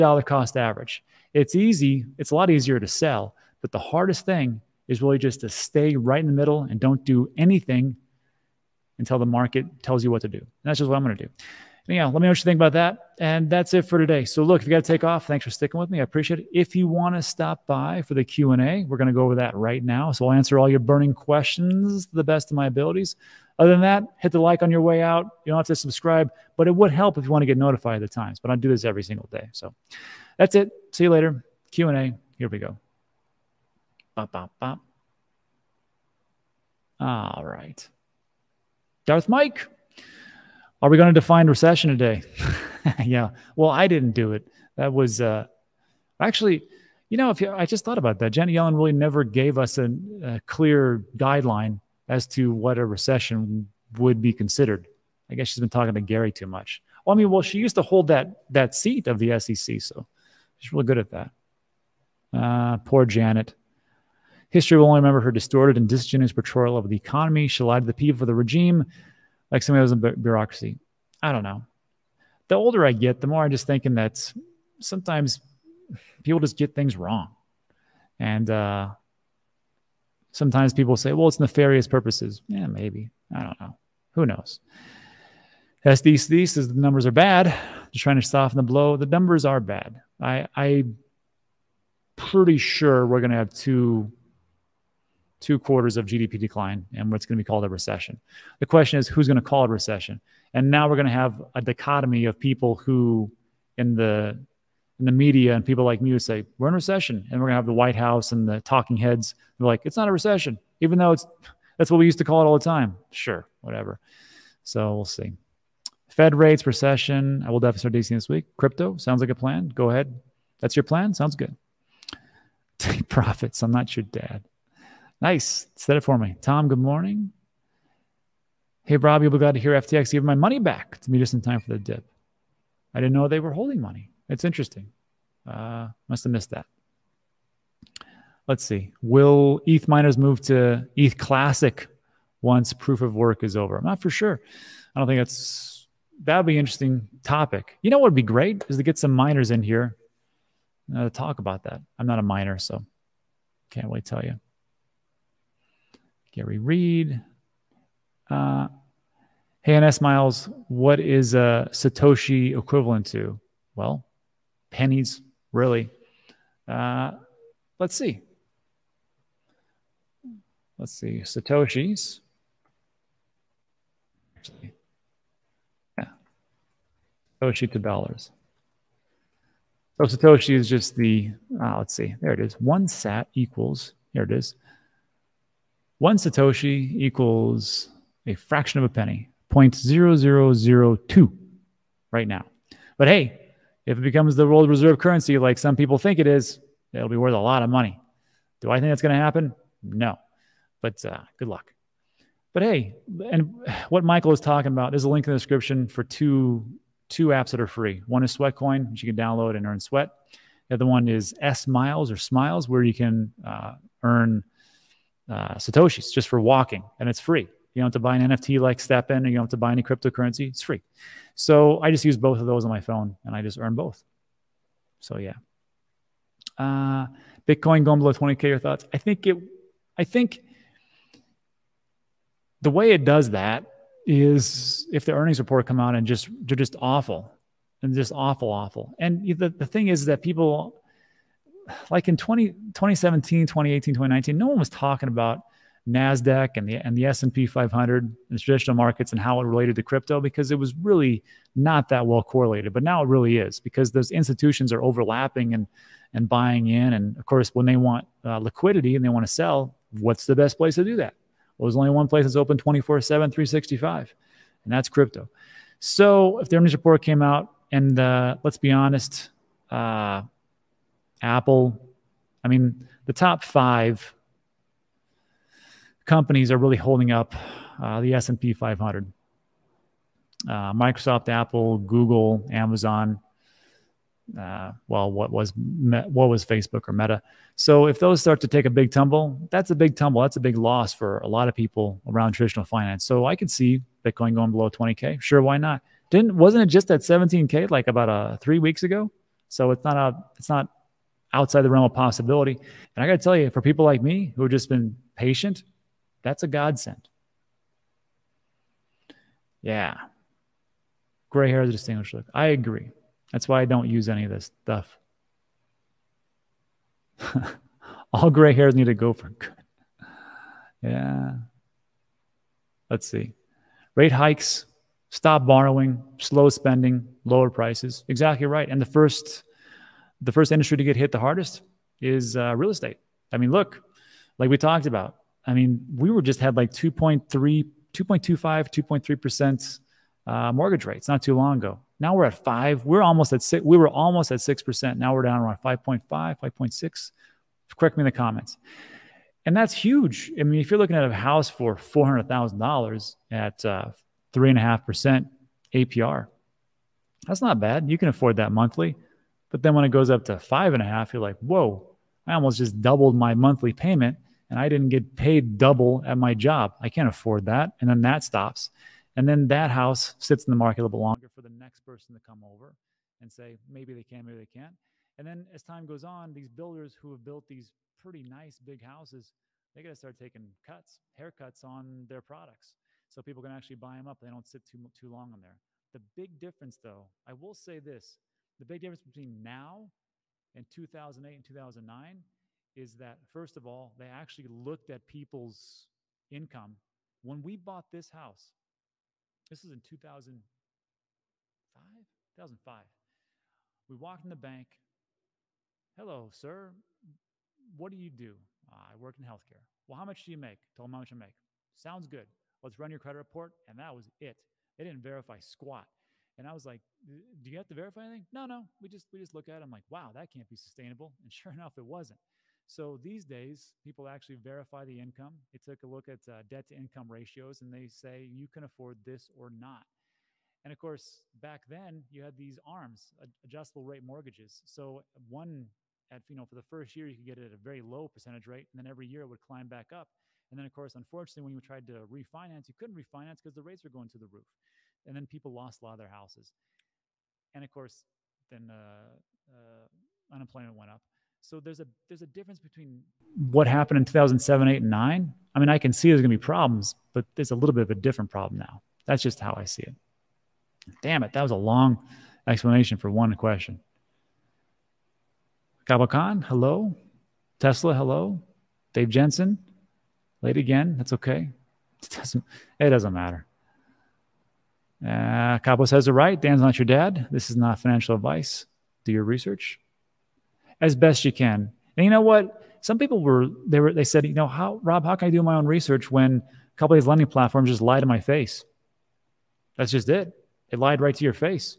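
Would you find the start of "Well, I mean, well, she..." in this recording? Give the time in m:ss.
0:57.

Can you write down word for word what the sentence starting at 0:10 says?
And that's just what I'm going to do.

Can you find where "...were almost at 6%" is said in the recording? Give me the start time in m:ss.
5:43.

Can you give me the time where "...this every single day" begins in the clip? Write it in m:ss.
0:28.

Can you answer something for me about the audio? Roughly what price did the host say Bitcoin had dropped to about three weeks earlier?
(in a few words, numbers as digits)
17k.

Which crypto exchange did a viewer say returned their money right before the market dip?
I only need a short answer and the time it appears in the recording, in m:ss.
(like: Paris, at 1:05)
FTX, at 2:09.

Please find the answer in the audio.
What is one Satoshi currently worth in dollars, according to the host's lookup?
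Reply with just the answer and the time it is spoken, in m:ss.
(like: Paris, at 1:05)
0.0002, at 3:09.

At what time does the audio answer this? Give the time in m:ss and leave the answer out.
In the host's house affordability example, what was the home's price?
5:51.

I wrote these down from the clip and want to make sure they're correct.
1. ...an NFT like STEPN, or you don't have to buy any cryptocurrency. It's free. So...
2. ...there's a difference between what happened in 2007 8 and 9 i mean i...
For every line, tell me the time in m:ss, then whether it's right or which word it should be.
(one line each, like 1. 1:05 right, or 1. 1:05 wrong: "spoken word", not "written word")
1. 3:38 right
2. 7:32 right.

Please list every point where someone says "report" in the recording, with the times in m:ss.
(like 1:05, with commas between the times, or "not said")
3:55, 4:26, 6:53.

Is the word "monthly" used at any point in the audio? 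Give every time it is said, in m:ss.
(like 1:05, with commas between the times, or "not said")
5:58, 6:03.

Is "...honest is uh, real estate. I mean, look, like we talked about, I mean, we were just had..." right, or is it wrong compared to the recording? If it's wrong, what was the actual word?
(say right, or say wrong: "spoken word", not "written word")
wrong: "hardest", not "honest".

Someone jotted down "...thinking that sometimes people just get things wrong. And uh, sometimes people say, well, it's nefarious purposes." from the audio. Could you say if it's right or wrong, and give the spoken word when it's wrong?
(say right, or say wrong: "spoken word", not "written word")
right.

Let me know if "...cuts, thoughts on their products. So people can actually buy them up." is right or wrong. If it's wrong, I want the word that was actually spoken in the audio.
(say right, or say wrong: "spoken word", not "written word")
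wrong: "haircuts", not "thoughts".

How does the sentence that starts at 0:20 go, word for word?
So I'll answer all your burning questions to the best of my abilities.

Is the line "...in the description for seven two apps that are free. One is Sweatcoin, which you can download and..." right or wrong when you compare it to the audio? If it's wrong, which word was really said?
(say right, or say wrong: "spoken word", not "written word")
wrong: "two", not "seven".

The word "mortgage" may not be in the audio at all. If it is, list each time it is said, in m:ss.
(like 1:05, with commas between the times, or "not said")
5:40, 7:14.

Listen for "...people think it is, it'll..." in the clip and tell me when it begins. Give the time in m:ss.
3:15.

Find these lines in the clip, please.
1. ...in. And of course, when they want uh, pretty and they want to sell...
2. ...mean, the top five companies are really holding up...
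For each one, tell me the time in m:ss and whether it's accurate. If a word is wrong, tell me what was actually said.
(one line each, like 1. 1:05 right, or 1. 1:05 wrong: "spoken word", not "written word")
1. 4:16 wrong: "liquidity", not "pretty"
2. 4:32 right.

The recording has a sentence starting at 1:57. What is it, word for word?
I will definitely start DC this week.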